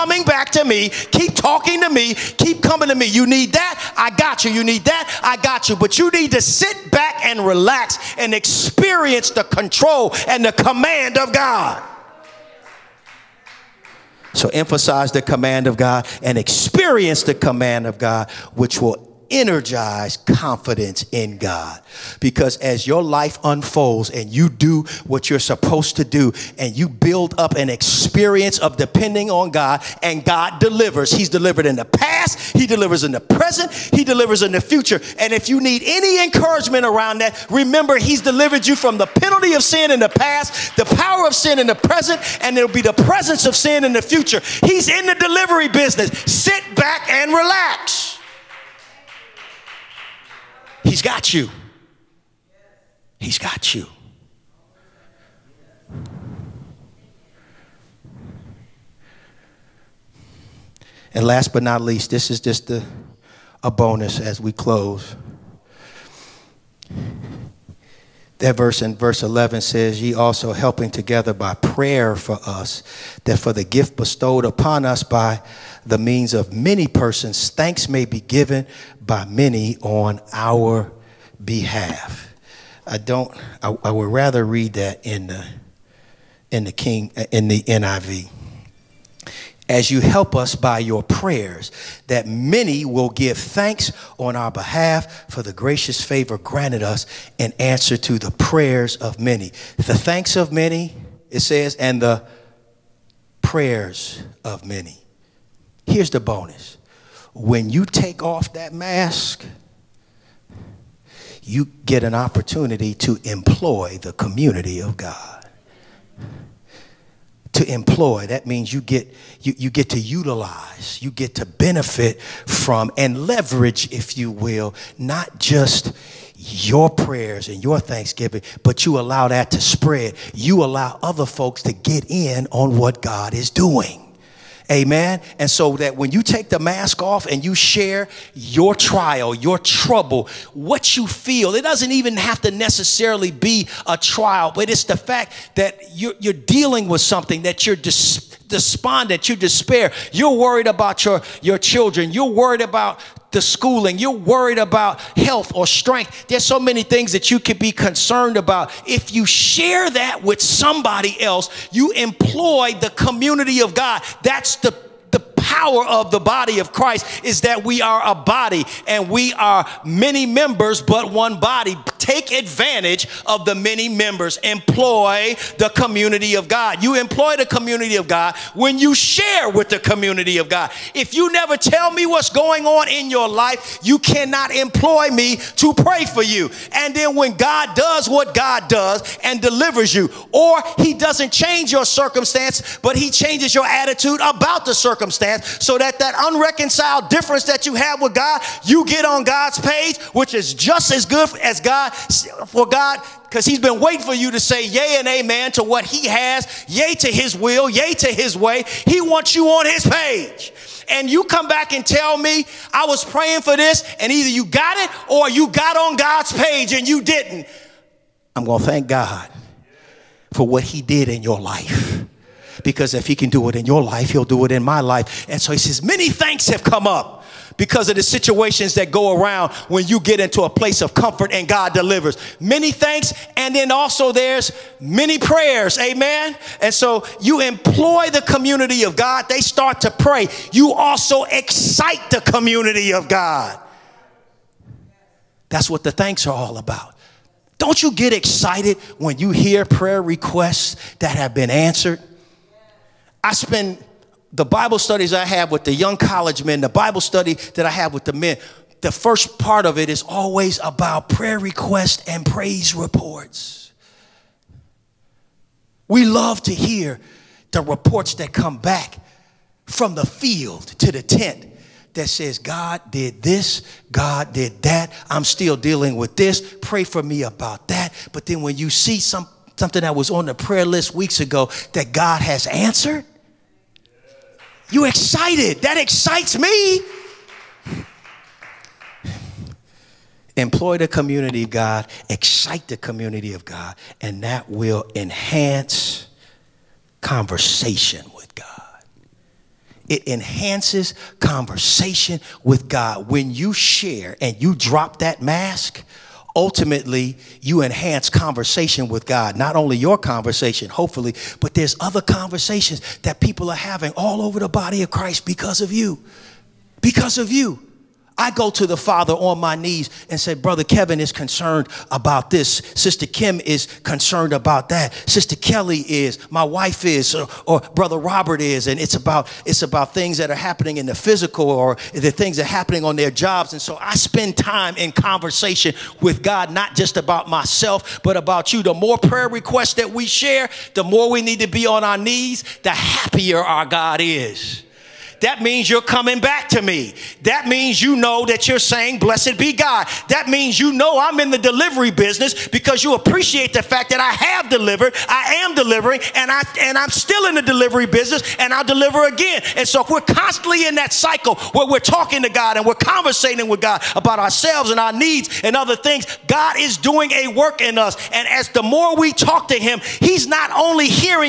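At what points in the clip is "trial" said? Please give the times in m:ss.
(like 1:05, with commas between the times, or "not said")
2:18, 2:23.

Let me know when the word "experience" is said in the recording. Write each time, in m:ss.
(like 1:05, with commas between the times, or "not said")
0:08, 0:16, 0:27.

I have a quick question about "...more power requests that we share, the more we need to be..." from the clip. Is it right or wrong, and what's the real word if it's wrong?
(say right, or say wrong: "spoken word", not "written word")
wrong: "prayer", not "power".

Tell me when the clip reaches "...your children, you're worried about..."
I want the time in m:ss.
2:31.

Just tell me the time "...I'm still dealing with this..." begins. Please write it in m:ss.
4:35.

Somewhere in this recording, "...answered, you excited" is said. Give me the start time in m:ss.
4:42.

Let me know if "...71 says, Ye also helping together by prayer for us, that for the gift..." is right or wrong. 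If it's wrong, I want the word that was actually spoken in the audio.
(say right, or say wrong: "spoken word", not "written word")
wrong: "11", not "71".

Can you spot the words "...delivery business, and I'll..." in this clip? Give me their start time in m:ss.
5:57.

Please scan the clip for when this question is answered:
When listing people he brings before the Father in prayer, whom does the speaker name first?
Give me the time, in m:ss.
5:20.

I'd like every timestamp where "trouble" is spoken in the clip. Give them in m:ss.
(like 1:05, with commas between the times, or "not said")
2:19.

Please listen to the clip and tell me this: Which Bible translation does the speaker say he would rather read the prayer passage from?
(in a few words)
NIV.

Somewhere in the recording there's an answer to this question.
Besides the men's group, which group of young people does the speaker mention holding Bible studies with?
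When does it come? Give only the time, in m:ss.
4:15.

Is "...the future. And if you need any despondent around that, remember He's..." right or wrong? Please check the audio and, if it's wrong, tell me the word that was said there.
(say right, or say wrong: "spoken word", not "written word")
wrong: "encouragement", not "despondent".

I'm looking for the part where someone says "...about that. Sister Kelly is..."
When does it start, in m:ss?
5:24.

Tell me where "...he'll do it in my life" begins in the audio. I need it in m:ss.
3:44.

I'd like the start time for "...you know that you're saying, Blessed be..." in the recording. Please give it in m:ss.
5:47.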